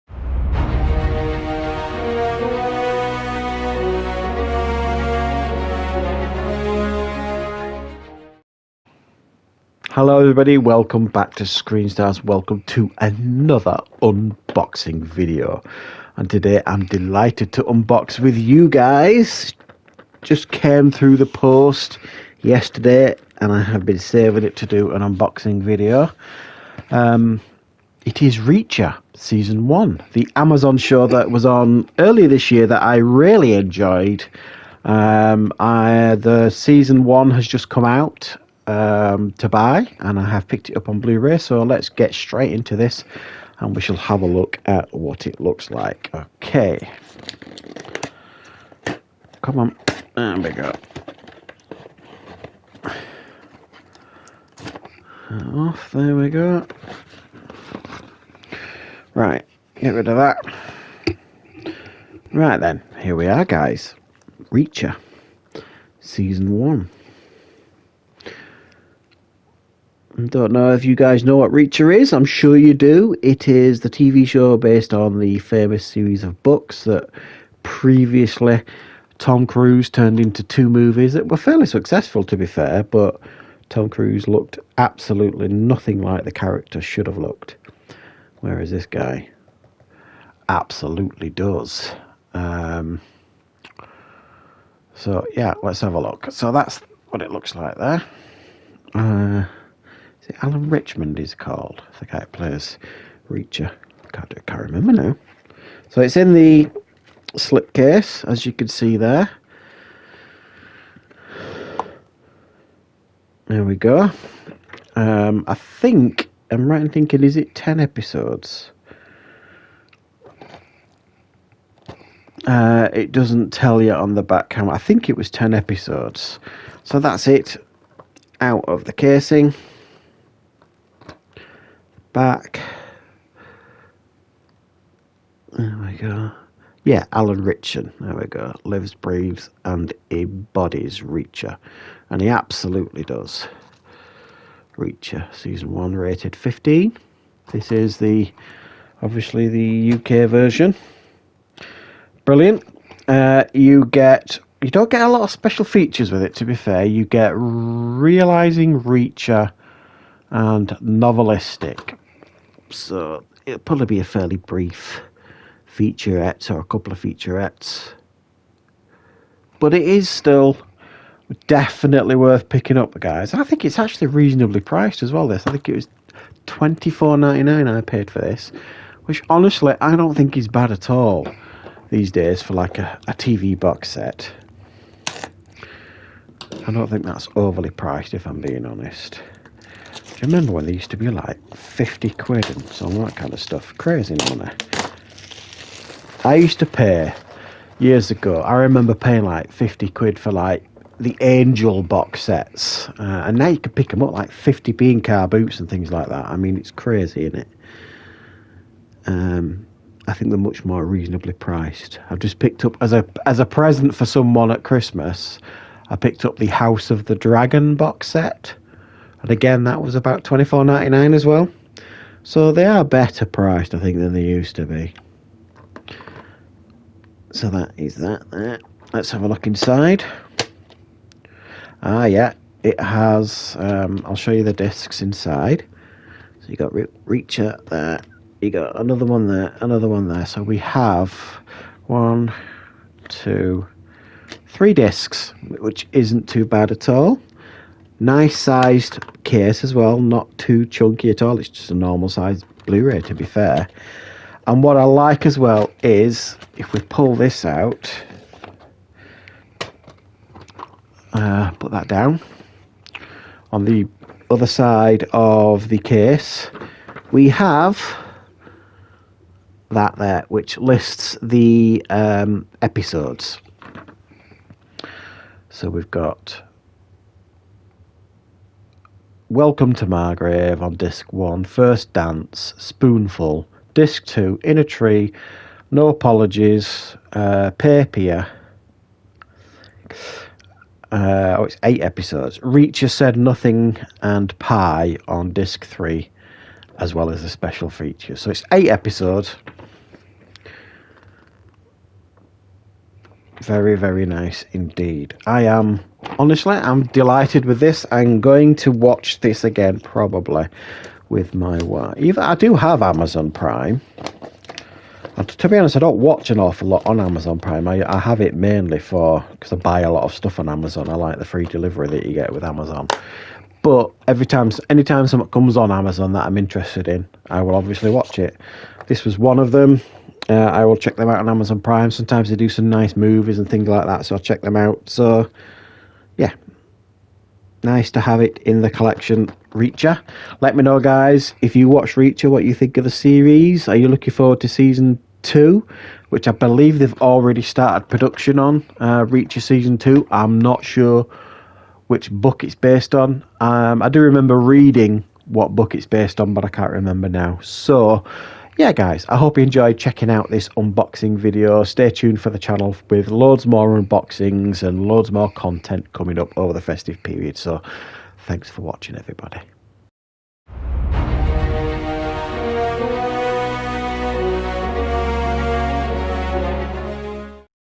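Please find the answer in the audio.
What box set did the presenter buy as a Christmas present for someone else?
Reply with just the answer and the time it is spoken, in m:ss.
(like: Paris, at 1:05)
House of the Dragon, at 3:36.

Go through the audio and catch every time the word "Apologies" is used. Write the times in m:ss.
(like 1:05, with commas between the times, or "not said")
4:45.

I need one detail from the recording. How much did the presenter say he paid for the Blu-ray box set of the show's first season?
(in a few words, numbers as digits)
£24.99.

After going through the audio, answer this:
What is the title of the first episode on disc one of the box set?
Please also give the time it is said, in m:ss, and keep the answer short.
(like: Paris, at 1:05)
Welcome to Margrave, at 4:39.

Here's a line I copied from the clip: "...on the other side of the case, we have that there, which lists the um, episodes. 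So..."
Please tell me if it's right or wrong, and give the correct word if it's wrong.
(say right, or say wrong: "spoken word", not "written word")
right.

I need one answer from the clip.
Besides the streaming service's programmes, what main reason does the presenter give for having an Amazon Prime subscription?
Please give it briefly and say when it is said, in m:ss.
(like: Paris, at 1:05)
free delivery, at 5:21.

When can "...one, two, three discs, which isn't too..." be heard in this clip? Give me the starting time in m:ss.
4:01.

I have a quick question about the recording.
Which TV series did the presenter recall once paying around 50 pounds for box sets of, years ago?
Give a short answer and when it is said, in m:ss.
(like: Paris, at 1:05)
Angel, at 3:21.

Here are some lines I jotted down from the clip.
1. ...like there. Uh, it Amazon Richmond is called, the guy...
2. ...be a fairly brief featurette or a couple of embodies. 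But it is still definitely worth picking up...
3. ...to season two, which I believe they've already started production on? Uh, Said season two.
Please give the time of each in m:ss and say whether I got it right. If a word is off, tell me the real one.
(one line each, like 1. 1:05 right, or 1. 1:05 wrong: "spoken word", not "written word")
1. 1:37 wrong: "Alan", not "Amazon"
2. 2:43 wrong: "featurettes", not "embodies"
3. 5:44 wrong: "Reacher", not "Said".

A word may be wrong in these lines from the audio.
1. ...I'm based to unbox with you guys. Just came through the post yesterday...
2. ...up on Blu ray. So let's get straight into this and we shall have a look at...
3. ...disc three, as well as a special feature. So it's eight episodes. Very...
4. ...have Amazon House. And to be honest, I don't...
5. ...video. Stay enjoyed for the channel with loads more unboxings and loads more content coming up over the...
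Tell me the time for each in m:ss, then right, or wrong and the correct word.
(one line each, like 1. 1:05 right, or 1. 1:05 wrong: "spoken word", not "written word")
1. 0:16 wrong: "delighted", not "based"
2. 0:40 right
3. 4:55 right
4. 5:12 wrong: "Prime", not "House"
5. 6:01 wrong: "tuned", not "enjoyed".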